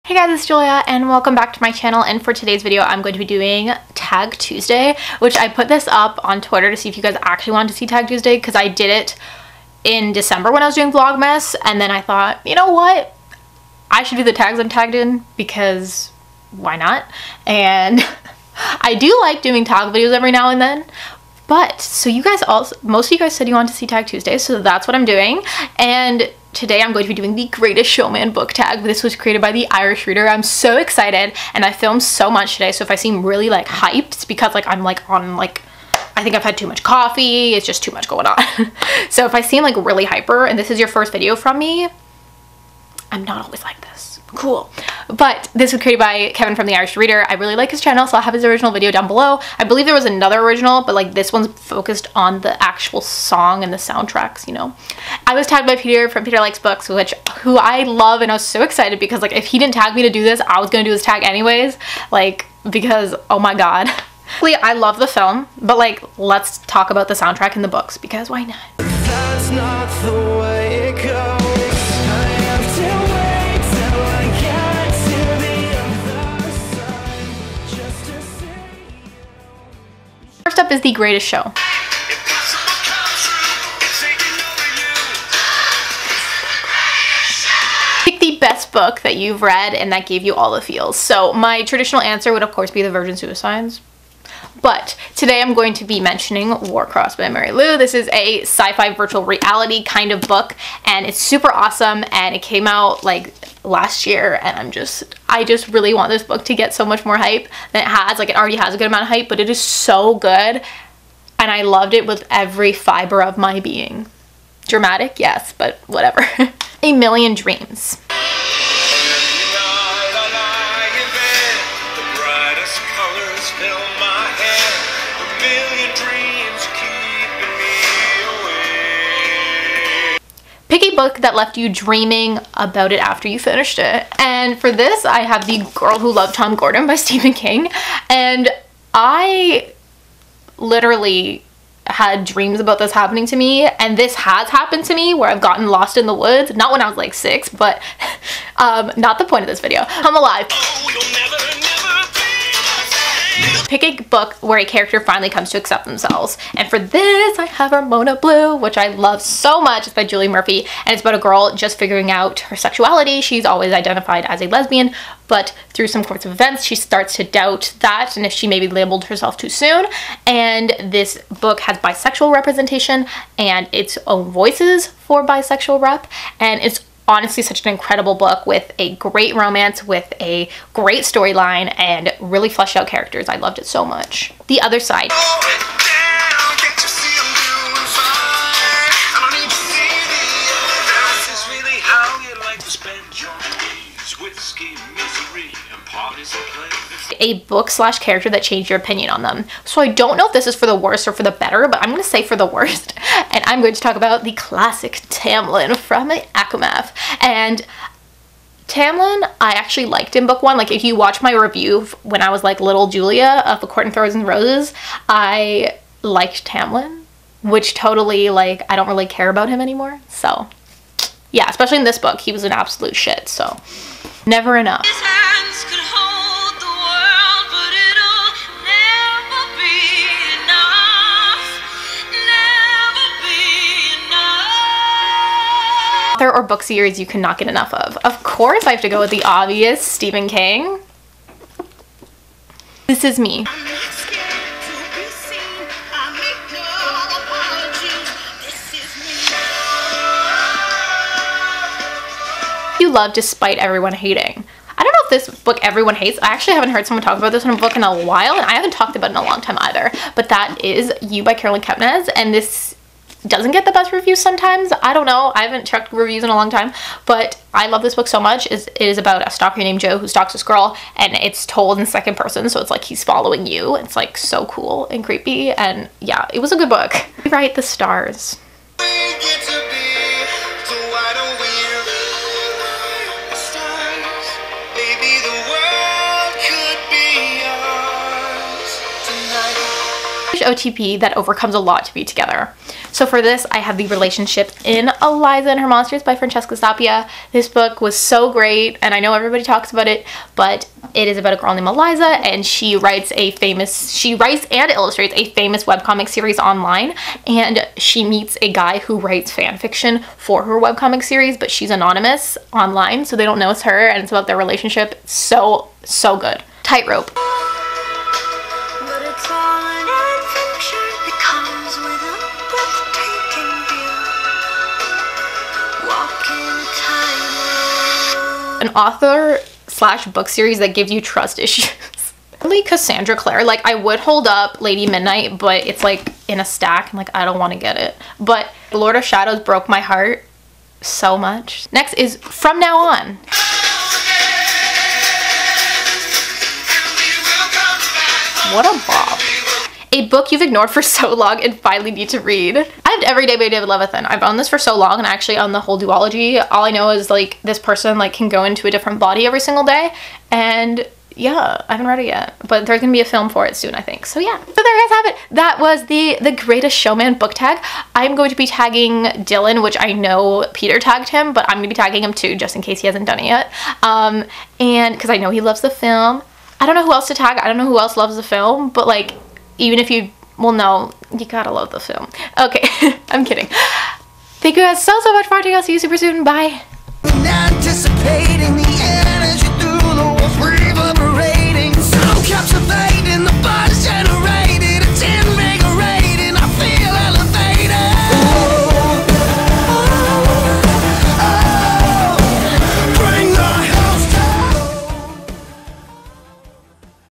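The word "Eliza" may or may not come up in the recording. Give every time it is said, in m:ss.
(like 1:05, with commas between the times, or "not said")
4:55, 5:01.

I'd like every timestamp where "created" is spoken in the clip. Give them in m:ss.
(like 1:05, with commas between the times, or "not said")
0:29, 0:45.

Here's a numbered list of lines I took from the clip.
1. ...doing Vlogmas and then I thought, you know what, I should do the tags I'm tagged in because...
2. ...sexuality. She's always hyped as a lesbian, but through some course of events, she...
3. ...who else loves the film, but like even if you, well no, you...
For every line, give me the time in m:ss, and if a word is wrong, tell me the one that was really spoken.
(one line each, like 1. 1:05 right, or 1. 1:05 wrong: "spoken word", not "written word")
1. 0:10 right
2. 2:42 wrong: "identified", not "hyped"
3. 6:17 right.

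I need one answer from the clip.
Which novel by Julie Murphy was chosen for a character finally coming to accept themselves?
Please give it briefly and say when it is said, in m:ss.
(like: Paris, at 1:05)
Ramona Blue, at 2:37.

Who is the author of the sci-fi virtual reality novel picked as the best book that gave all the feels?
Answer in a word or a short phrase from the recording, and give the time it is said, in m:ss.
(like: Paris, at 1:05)
Marie Lu, at 1:37.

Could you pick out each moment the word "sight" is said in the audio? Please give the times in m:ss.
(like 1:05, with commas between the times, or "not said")
not said.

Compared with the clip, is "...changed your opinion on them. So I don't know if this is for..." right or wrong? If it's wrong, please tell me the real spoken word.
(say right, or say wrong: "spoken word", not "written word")
right.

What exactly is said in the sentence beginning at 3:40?
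So, yeah, especially in this book, he was an absolute shit.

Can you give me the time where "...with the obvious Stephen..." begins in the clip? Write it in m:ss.
3:58.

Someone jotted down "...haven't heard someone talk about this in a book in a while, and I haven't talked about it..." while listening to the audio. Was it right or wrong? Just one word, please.
right.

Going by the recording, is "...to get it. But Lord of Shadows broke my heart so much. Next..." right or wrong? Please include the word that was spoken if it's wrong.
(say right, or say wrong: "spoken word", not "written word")
right.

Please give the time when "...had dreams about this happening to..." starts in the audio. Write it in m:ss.
2:21.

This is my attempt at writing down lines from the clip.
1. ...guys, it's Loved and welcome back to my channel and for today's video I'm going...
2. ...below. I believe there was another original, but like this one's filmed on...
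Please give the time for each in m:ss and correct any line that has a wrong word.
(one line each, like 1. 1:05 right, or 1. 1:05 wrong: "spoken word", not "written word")
1. 0:00 wrong: "Julia", not "Loved"
2. 0:49 wrong: "focused", not "filmed".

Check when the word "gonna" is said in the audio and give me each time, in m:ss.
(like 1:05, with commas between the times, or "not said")
1:00, 6:02, 6:11.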